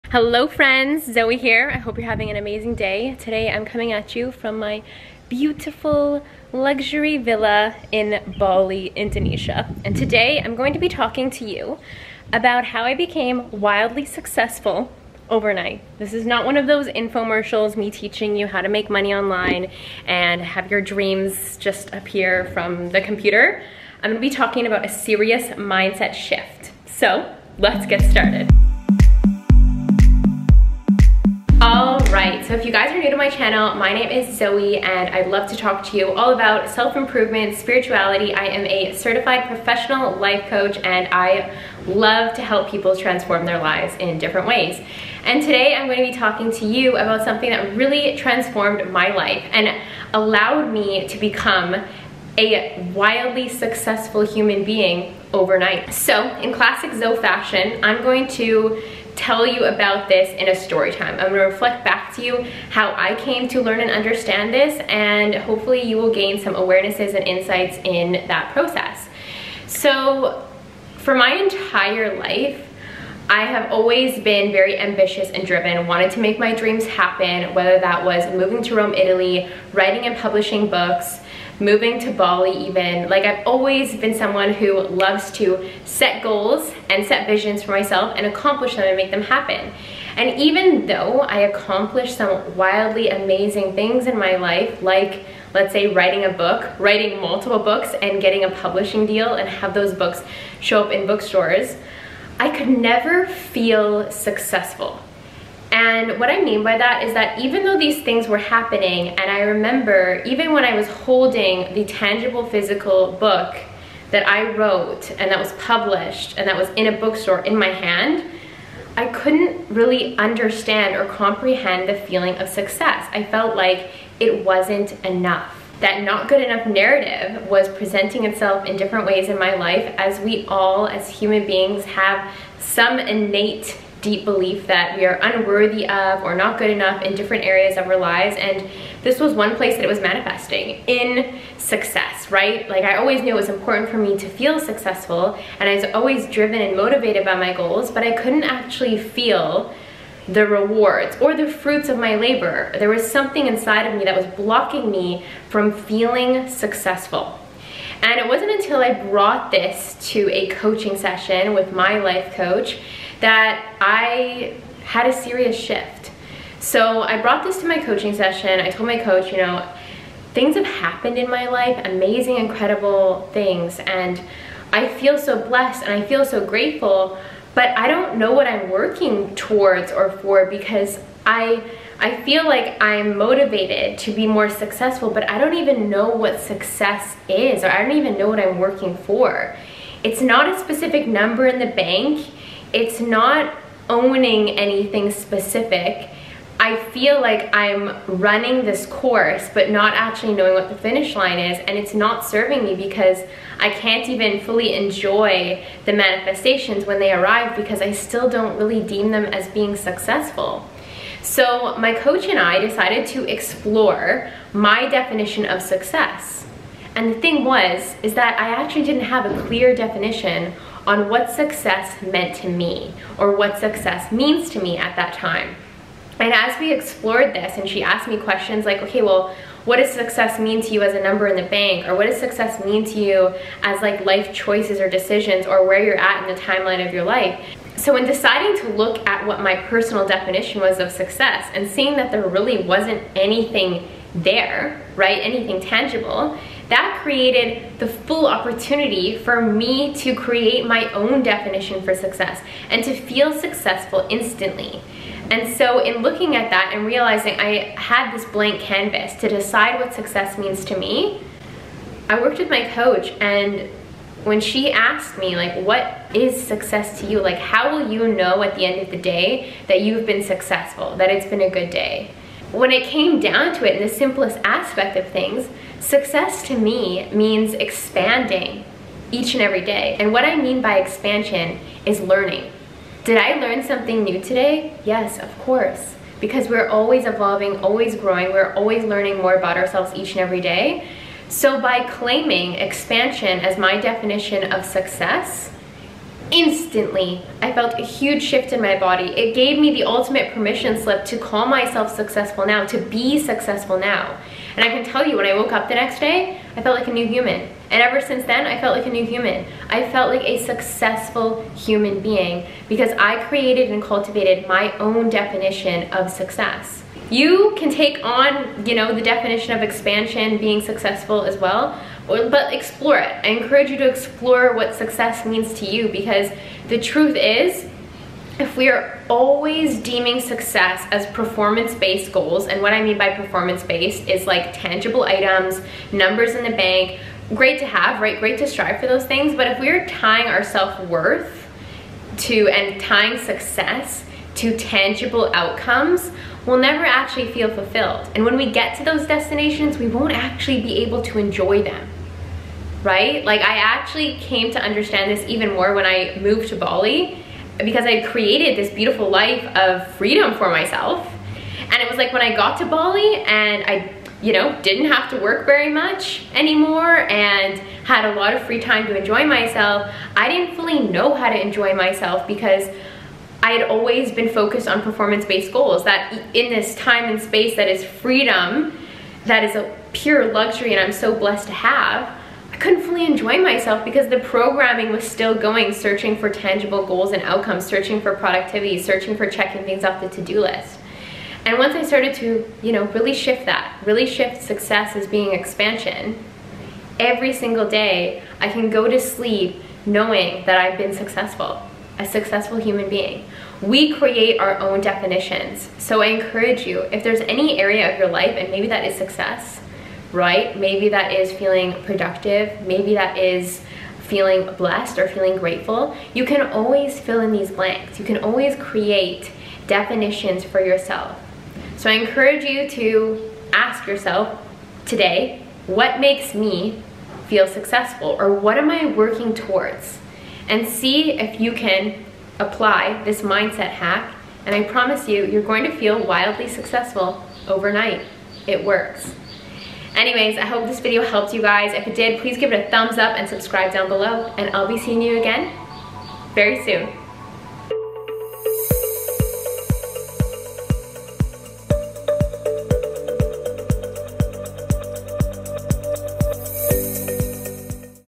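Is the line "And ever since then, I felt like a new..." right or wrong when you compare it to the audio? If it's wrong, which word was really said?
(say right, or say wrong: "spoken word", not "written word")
right.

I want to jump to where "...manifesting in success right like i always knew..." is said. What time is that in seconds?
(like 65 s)
139 s.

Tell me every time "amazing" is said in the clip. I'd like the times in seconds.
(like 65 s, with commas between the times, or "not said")
2 s, 93 s, 171 s.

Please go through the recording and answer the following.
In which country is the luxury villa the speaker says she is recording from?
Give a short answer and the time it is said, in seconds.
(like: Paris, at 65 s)
Indonesia, at 8 s.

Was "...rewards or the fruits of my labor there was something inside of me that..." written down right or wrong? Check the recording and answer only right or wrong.
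right.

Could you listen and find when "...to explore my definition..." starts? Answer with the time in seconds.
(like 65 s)
213 s.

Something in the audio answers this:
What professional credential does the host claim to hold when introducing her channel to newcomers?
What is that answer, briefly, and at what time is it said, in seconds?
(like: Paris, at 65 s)
certified professional life coach, at 38 s.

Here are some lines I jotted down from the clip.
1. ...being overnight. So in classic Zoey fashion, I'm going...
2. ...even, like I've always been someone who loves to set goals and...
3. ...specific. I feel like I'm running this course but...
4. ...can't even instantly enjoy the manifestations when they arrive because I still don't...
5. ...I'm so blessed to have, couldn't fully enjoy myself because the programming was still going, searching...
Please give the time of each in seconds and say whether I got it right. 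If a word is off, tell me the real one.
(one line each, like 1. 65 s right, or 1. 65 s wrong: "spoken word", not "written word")
1. 54 s right
2. 82 s right
3. 195 s right
4. 203 s wrong: "fully", not "instantly"
5. 380 s right.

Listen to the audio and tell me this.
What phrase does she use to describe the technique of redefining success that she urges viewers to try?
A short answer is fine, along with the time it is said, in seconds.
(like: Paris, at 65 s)
mindset hack, at 433 s.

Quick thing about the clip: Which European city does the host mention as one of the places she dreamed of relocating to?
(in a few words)
Rome.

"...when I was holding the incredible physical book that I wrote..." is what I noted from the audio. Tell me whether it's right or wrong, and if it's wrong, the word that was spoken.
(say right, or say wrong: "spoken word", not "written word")
wrong: "tangible", not "incredible".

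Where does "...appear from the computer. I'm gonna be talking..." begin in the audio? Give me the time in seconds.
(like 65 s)
21 s.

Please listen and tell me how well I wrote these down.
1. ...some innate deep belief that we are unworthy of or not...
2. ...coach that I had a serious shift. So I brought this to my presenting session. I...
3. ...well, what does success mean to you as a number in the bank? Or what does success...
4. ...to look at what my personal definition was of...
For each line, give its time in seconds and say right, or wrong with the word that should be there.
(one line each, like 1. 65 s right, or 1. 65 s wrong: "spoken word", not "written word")
1. 132 s right
2. 162 s wrong: "coaching", not "presenting"
3. 229 s right
4. 238 s right.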